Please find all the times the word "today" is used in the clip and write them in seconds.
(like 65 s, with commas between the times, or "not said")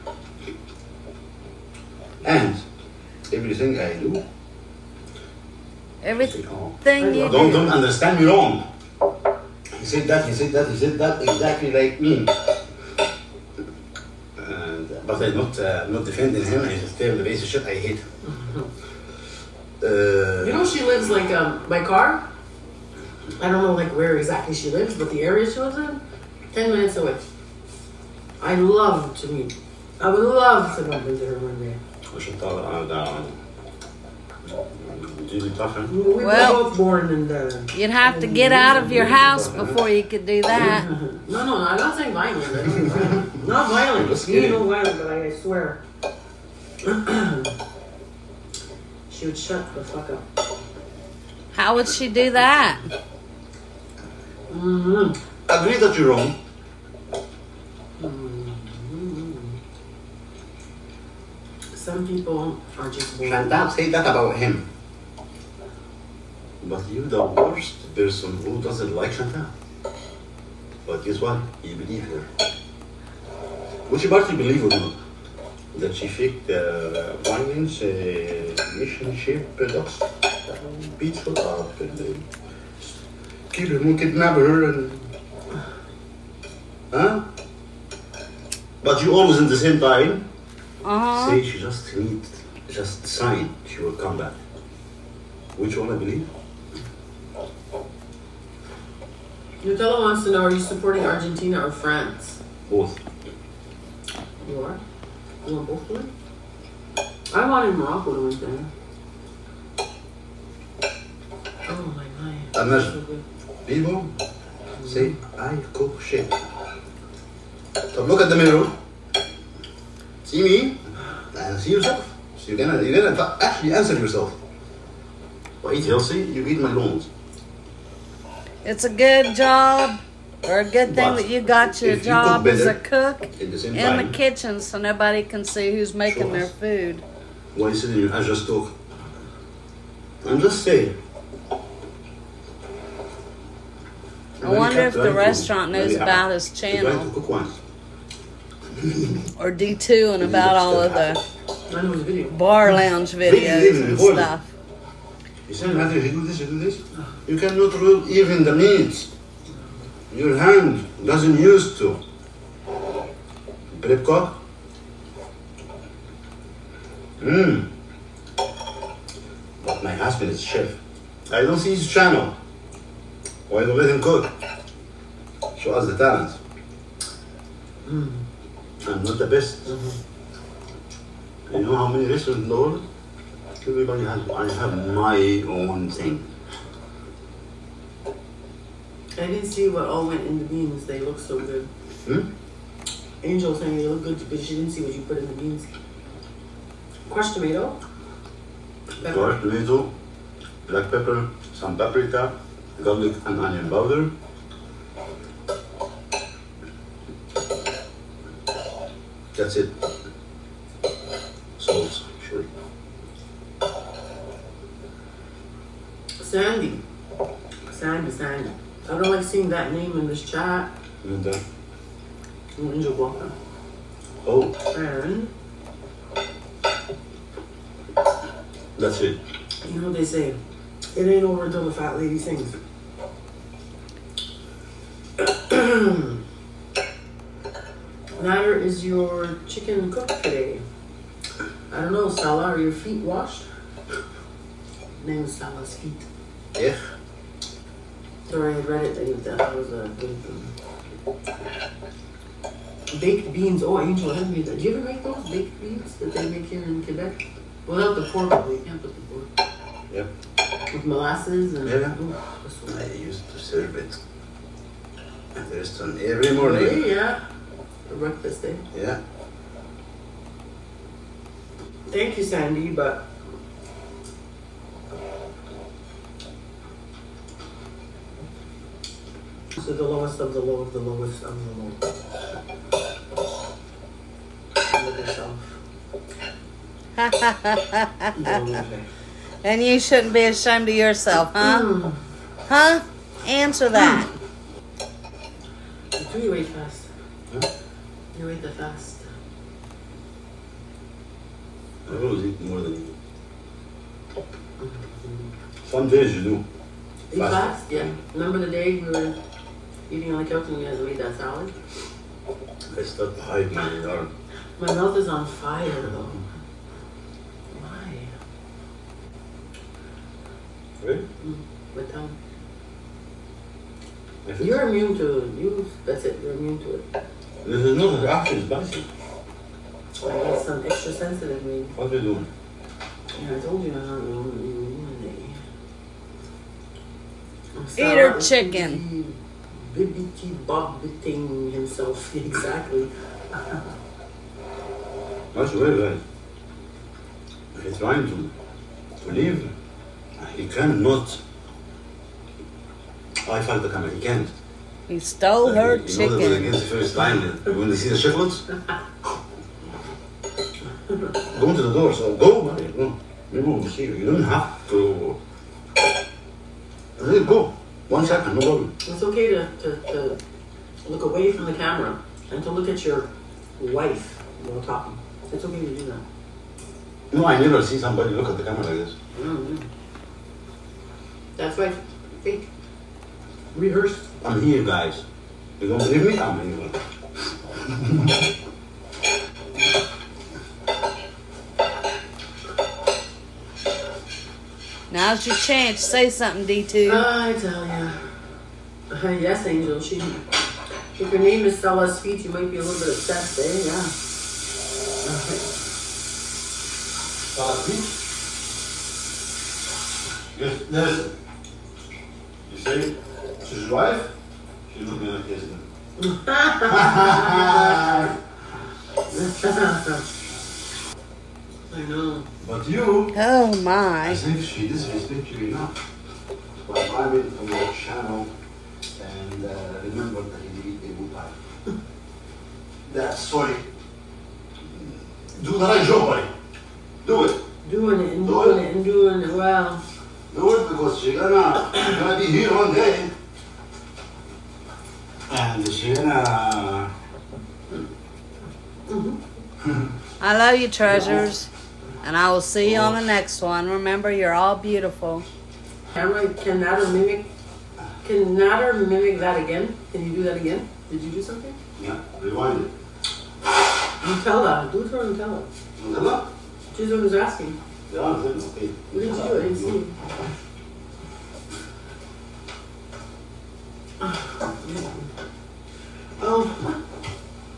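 108 s, 240 s.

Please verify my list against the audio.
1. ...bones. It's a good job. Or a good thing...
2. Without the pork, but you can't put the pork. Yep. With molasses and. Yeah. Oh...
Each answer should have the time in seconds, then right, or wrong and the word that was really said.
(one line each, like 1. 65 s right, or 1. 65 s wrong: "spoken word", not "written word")
1. 126 s right
2. 257 s right.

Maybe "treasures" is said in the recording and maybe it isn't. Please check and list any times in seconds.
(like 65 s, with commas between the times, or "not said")
450 s.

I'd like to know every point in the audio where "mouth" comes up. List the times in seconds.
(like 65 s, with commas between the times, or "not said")
314 s.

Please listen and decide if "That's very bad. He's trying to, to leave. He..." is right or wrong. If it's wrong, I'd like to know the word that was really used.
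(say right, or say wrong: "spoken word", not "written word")
right.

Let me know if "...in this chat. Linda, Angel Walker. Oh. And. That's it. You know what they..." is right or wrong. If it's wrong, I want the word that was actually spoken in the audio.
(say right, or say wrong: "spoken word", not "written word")
right.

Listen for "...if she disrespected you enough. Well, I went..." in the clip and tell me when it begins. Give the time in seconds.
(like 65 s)
424 s.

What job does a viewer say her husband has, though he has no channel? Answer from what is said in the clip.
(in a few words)
Chef.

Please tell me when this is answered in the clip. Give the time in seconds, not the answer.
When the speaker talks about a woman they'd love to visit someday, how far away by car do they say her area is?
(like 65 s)
26 s.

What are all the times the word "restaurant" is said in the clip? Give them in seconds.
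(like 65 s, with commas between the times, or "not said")
145 s, 182 s, 265 s.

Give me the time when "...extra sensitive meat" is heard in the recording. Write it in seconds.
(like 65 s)
330 s.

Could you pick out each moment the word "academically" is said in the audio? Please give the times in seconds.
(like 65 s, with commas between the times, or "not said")
not said.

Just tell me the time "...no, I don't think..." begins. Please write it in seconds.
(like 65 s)
41 s.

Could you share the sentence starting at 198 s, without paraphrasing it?
Crushed tomato, black pepper, some paprika, garlic and onion powder.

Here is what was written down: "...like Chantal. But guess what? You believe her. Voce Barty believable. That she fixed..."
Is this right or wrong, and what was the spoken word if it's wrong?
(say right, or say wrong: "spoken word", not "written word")
right.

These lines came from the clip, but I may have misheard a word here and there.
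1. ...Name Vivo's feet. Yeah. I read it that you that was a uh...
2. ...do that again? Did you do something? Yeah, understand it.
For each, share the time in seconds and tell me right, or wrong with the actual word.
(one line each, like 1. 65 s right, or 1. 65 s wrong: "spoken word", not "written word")
1. 245 s wrong: "Sala", not "Vivo"
2. 460 s wrong: "rewind", not "understand".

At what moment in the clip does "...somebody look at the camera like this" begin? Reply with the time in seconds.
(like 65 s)
377 s.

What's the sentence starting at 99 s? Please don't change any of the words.
Nutella wants to know are you supporting Argentina or France?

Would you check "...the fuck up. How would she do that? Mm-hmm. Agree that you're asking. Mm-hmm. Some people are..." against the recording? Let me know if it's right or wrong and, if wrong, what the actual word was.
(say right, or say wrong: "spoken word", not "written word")
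wrong: "wrong", not "asking".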